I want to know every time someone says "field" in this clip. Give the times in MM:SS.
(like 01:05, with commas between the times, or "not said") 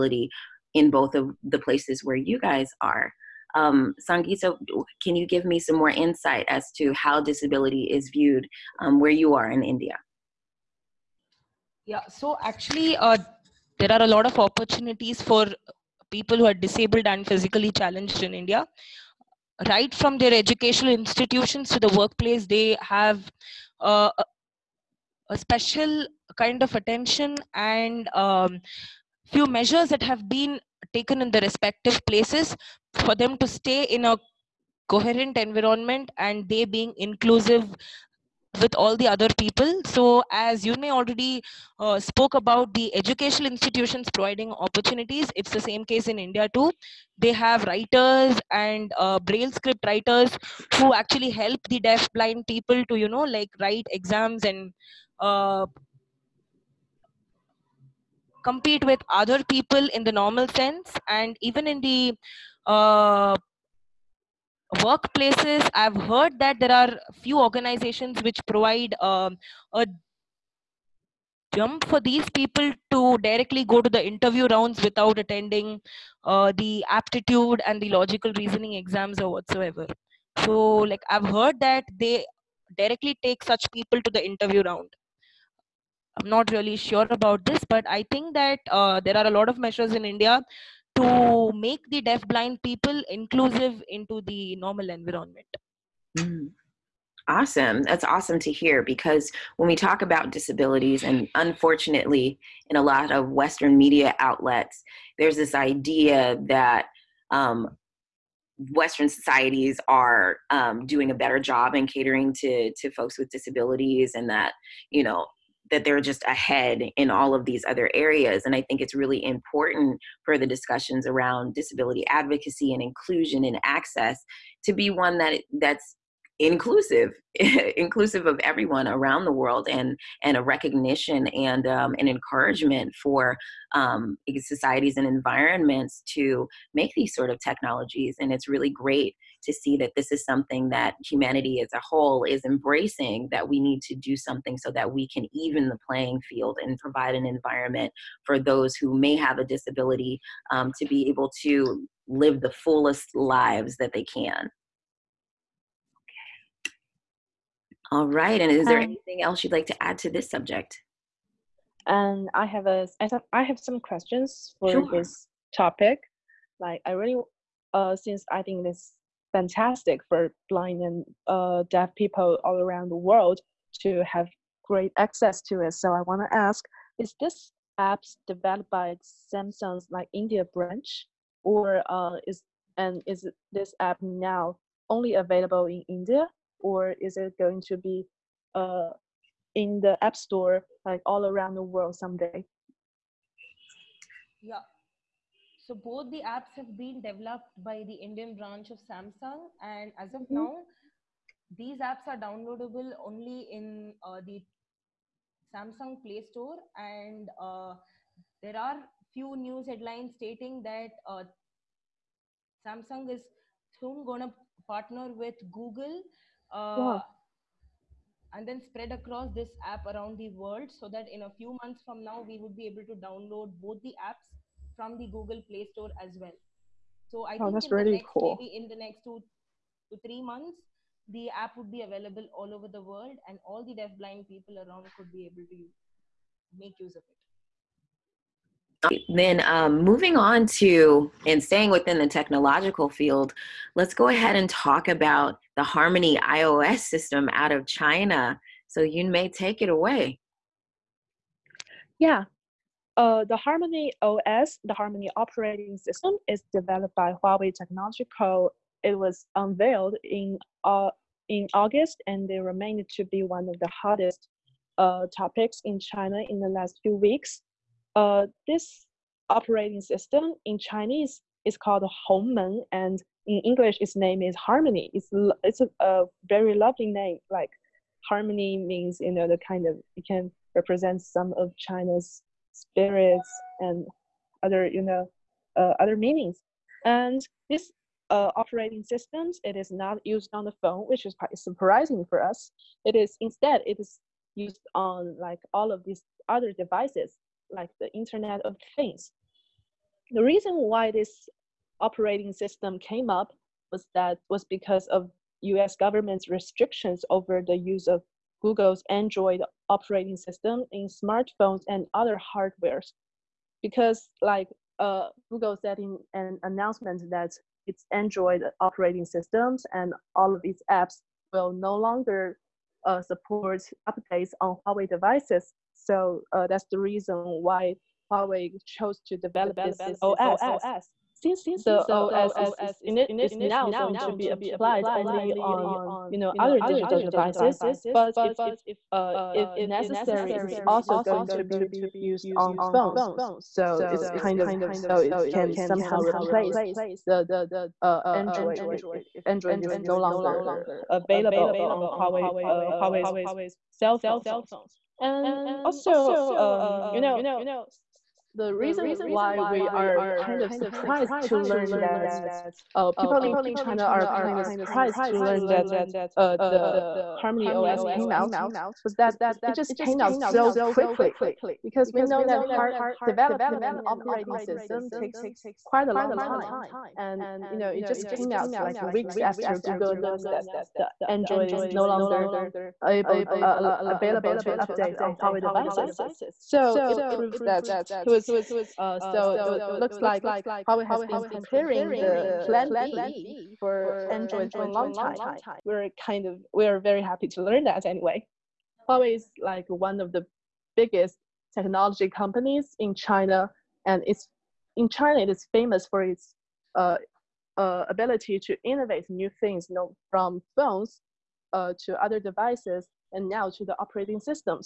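02:26, 04:02.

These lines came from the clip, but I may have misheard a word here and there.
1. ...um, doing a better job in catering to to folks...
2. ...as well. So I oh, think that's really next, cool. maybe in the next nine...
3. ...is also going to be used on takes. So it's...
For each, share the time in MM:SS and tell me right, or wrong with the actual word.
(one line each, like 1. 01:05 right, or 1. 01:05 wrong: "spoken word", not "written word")
1. 01:50 right
2. 03:46 wrong: "two", not "nine"
3. 05:40 wrong: "phones", not "takes".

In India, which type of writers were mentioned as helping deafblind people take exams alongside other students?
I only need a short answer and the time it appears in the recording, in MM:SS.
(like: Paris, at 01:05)
Braille script writers, at 00:49.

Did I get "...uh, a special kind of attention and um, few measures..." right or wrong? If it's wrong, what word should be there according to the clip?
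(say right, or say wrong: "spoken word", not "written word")
right.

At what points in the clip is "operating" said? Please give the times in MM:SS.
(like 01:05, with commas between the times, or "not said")
04:15, 04:29, 04:48, 05:01, 05:09, 05:18, 06:13, 06:53.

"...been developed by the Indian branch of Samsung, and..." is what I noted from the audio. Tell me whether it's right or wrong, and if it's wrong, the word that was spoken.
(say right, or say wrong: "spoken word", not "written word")
right.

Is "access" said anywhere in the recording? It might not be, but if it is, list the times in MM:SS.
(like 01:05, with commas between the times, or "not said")
02:03, 02:54.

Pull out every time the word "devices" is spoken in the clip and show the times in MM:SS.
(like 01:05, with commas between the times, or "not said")
04:56, 05:24, 05:36, 06:25, 06:52.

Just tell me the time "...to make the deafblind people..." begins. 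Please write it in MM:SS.
01:30.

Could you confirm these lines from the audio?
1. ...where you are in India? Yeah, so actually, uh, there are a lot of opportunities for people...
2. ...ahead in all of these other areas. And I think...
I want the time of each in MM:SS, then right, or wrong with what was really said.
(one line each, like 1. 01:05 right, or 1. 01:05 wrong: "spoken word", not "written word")
1. 00:08 right
2. 01:56 right.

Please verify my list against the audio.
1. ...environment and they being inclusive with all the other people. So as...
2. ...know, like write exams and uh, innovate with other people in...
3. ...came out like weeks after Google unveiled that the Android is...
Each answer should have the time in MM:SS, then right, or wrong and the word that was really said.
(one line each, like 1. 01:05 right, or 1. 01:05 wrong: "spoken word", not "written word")
1. 00:35 right
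2. 00:53 wrong: "compete", not "innovate"
3. 06:18 wrong: "announced", not "unveiled".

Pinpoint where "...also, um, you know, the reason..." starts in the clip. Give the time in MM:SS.
05:55.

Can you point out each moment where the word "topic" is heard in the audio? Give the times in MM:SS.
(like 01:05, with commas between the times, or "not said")
02:45, 04:25.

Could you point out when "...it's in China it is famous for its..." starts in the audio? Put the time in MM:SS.
06:44.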